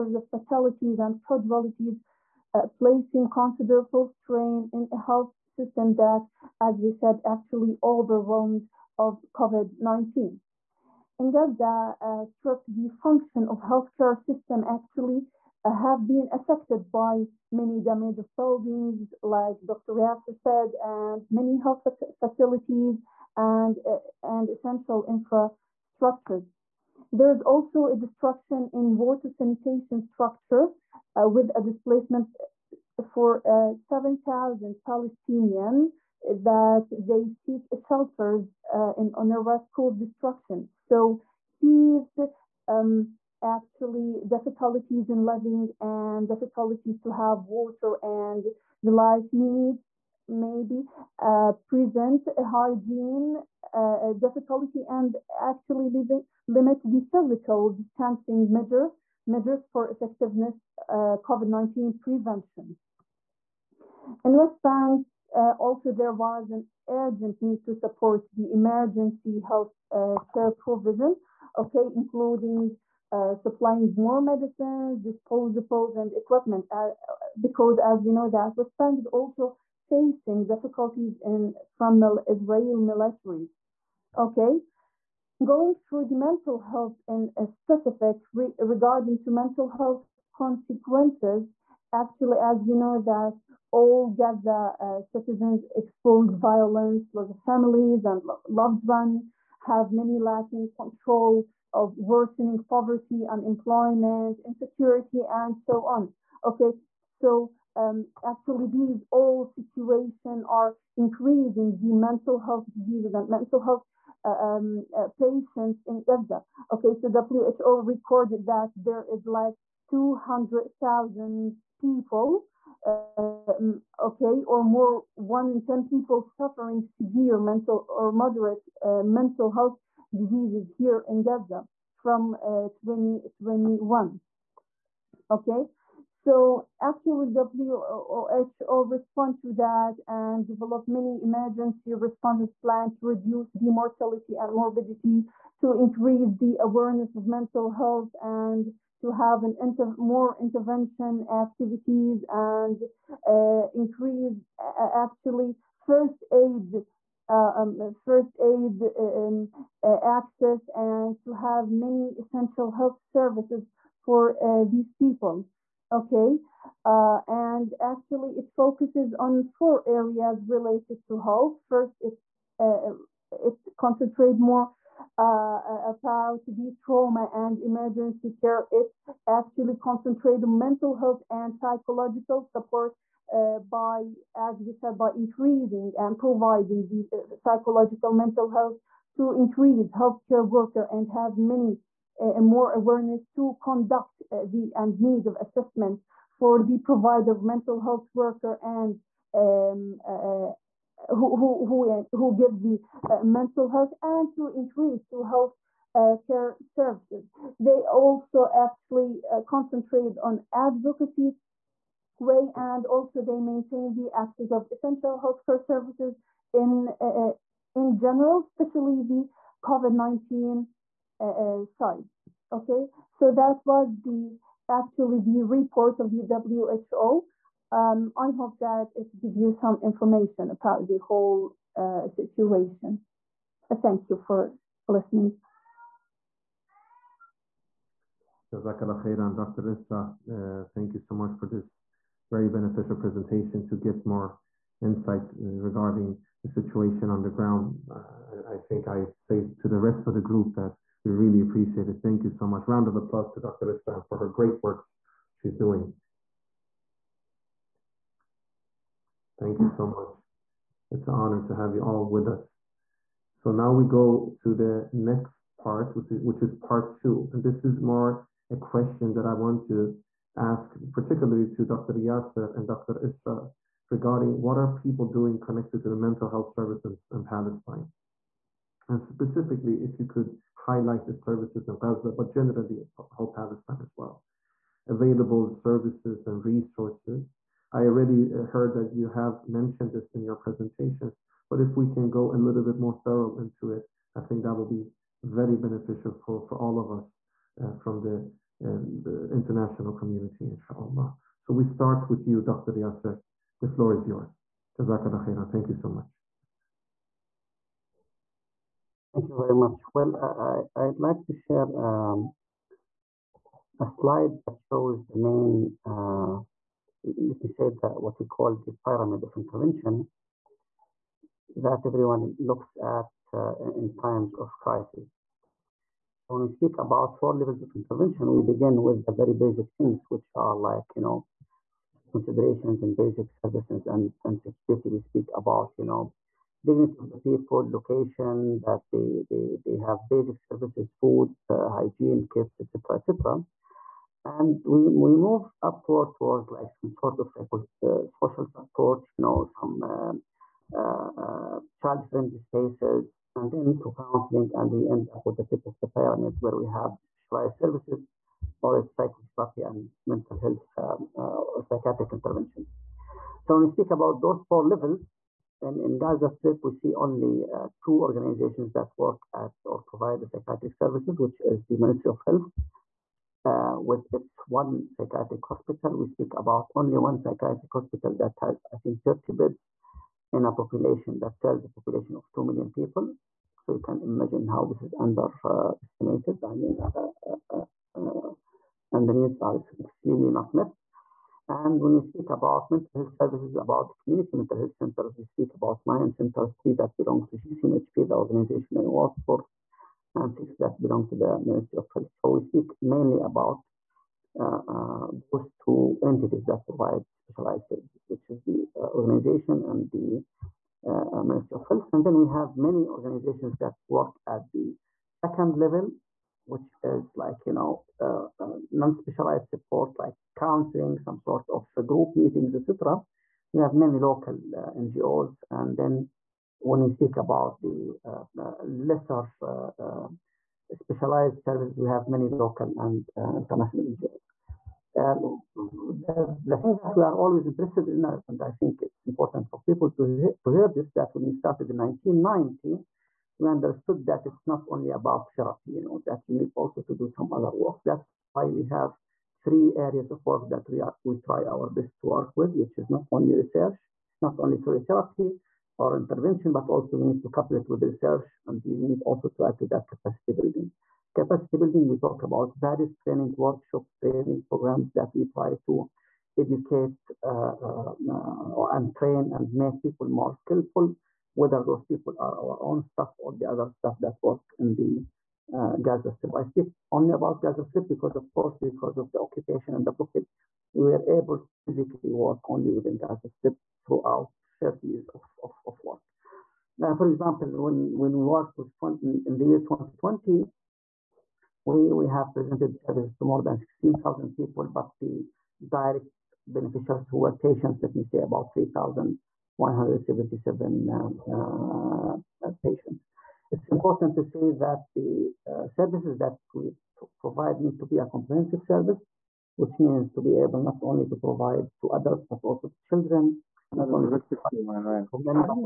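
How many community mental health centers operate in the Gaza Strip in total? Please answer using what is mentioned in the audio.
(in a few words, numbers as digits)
9.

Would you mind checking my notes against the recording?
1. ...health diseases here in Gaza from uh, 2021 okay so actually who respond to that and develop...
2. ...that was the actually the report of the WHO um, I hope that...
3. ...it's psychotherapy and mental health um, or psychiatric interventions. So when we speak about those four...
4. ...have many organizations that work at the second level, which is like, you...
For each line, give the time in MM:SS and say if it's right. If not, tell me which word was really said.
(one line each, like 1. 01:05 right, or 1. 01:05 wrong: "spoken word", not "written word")
1. 02:09 right
2. 03:43 right
3. 05:58 right
4. 06:52 right.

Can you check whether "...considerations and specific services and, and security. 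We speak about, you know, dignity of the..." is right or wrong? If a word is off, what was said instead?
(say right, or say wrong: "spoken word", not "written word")
wrong: "basic", not "specific".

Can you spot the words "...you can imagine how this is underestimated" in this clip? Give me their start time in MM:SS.
06:23.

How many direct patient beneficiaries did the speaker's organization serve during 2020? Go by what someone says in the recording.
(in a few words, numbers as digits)
3,177.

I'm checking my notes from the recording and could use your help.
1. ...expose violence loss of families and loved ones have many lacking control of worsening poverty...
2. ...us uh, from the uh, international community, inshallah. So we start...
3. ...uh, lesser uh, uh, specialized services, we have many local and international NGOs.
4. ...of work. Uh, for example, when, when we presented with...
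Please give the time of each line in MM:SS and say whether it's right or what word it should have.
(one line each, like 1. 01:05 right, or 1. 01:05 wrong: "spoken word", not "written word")
1. 01:35 right
2. 04:56 right
3. 07:08 right
4. 08:05 wrong: "worked", not "presented".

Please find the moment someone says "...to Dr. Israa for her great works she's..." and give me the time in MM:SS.
04:13.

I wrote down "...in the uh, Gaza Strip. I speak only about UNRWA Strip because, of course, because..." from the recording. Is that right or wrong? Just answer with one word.
wrong.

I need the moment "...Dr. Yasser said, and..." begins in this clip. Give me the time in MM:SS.
00:19.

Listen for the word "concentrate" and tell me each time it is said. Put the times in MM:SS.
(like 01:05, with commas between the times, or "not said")
02:53, 02:59, 03:29.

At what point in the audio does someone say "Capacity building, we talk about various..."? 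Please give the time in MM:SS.
07:41.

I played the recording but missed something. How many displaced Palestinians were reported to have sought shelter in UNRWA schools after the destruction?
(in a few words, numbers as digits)
7,000.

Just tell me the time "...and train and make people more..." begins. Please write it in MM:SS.
07:48.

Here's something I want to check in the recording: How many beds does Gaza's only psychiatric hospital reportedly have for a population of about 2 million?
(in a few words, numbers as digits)
30.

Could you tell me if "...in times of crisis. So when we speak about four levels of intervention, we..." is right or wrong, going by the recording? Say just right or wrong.
right.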